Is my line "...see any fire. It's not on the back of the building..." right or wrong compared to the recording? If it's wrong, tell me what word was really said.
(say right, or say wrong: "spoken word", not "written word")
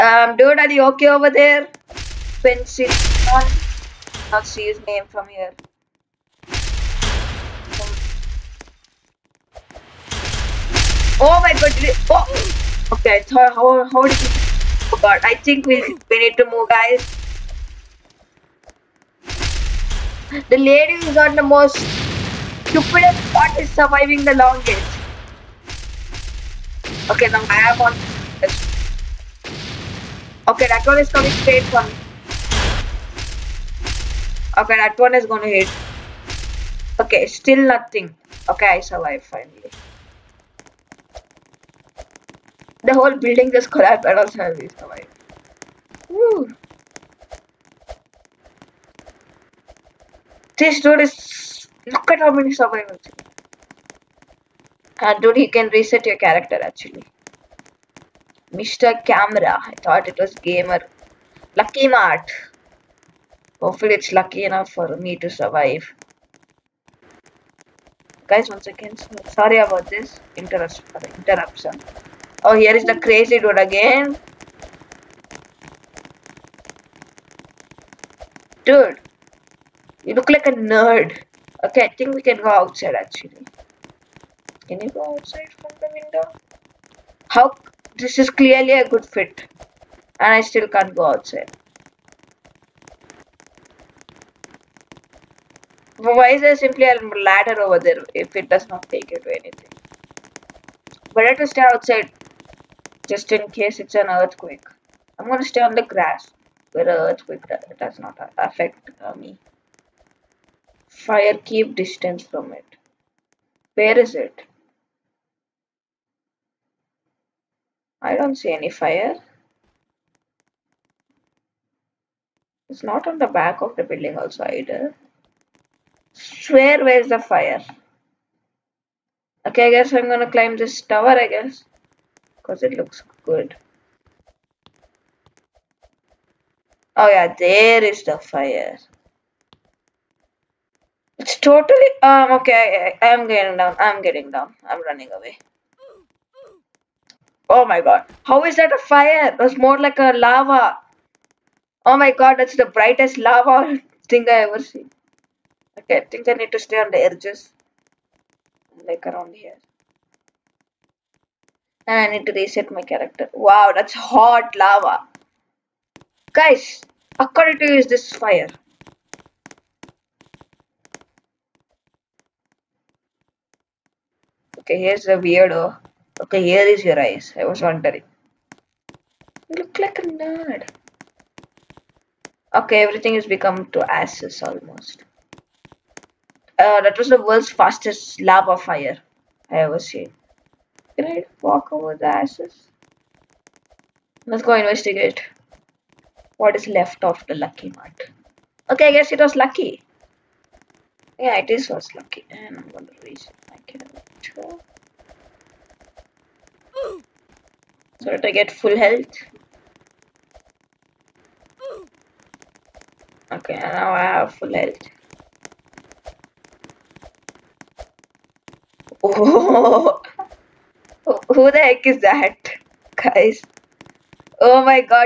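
right.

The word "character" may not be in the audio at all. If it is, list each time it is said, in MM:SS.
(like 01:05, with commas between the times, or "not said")
00:56, 02:42.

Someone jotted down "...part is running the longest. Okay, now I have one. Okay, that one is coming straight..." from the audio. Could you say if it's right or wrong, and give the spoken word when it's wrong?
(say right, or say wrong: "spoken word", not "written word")
wrong: "surviving", not "running".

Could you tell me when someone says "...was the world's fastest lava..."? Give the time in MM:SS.
03:06.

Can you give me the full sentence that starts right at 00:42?
The whole building just collapsed and also I survived.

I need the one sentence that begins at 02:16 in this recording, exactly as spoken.
Oh yeah, there is the fire.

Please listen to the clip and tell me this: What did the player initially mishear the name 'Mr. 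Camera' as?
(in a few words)
Gamer.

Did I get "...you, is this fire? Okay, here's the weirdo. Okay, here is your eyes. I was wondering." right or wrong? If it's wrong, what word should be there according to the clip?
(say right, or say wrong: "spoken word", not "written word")
right.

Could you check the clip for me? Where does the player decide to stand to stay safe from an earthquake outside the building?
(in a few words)
On the grass.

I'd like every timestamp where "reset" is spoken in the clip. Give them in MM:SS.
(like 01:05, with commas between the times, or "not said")
00:55, 02:42.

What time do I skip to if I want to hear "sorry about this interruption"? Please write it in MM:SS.
01:09.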